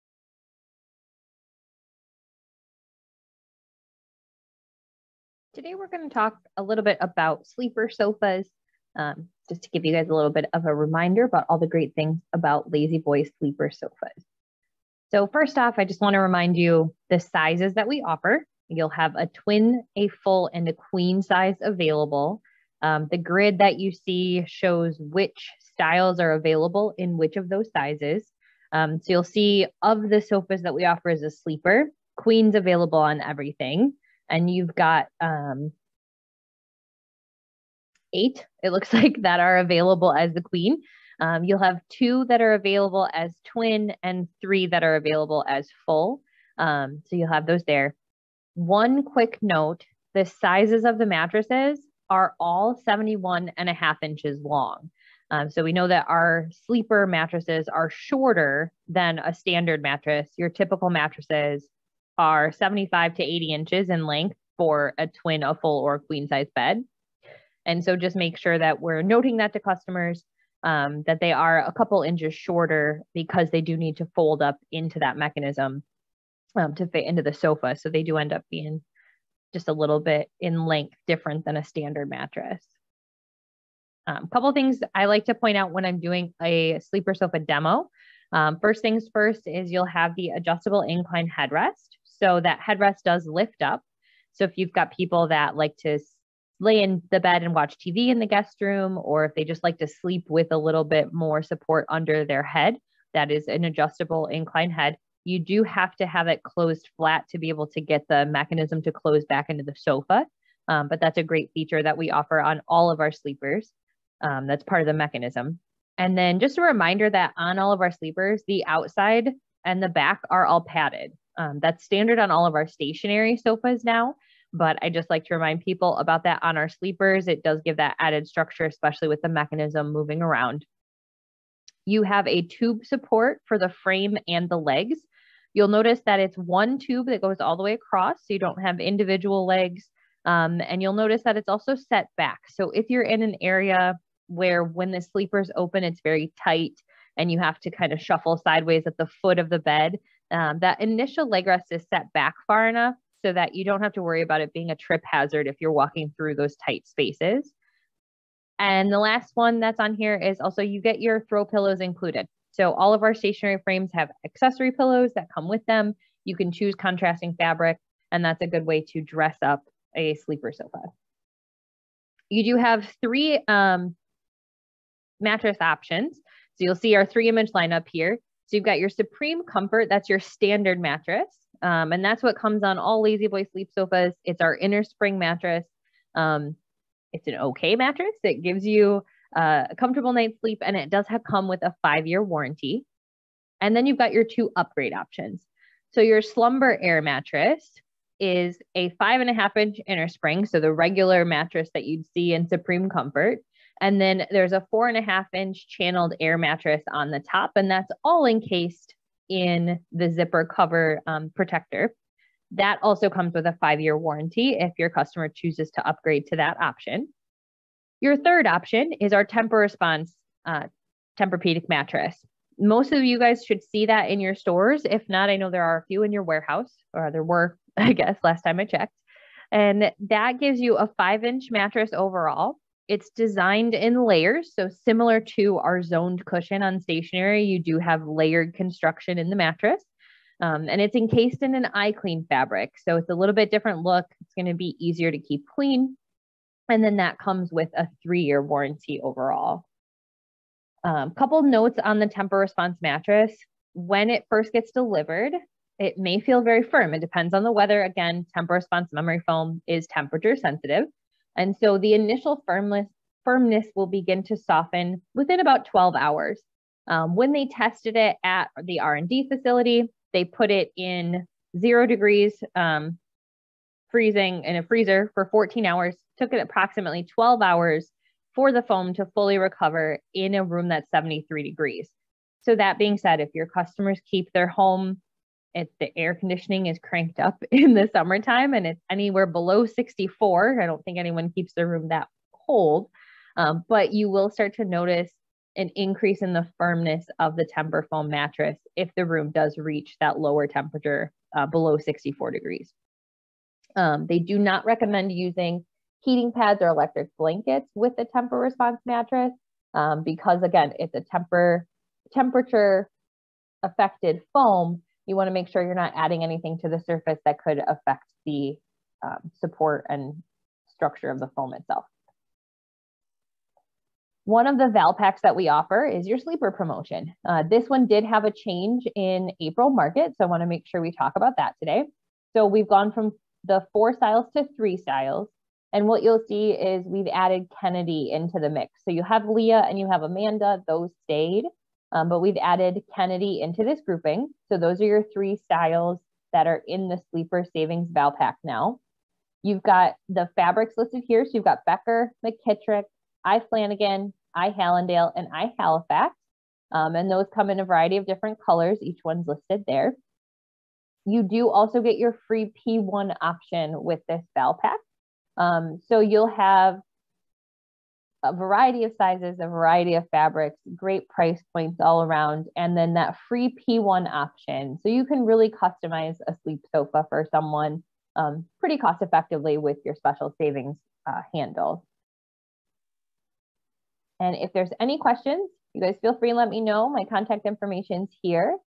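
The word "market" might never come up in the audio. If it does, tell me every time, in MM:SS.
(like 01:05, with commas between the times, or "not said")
05:29.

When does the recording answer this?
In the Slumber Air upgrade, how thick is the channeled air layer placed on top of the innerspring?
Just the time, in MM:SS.
03:24.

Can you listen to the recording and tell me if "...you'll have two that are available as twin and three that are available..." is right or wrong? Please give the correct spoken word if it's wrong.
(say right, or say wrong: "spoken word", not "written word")
right.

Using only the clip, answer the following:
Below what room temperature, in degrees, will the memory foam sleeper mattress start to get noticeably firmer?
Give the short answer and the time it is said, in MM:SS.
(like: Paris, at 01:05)
64 degrees, at 05:01.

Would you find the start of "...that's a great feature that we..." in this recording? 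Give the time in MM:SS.
01:51.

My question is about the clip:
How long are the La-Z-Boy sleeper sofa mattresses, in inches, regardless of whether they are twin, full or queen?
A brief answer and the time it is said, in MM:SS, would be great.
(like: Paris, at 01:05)
71.5 inches, at 00:52.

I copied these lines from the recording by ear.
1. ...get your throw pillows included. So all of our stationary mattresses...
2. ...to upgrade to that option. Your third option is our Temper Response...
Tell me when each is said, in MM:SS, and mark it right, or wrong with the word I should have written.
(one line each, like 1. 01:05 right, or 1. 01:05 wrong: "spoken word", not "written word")
1. 02:40 wrong: "frames", not "mattresses"
2. 03:35 right.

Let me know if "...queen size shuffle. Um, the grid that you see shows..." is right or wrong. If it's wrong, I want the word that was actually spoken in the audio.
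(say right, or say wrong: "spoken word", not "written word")
wrong: "available", not "shuffle".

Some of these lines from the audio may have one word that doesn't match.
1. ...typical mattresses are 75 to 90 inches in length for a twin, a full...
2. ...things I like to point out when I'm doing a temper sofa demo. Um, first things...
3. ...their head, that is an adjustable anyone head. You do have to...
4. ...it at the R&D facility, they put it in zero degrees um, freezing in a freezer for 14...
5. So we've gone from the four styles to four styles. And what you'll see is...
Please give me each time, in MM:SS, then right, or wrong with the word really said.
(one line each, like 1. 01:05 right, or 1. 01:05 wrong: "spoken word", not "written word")
1. 01:00 wrong: "80", not "90"
2. 01:24 wrong: "sleeper", not "temper"
3. 01:42 wrong: "incline", not "anyone"
4. 04:27 right
5. 05:32 wrong: "three", not "four".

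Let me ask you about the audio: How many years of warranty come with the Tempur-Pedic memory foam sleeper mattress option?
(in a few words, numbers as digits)
3 years.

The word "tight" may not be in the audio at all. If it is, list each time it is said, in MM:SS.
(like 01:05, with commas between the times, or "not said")
02:26, 02:36.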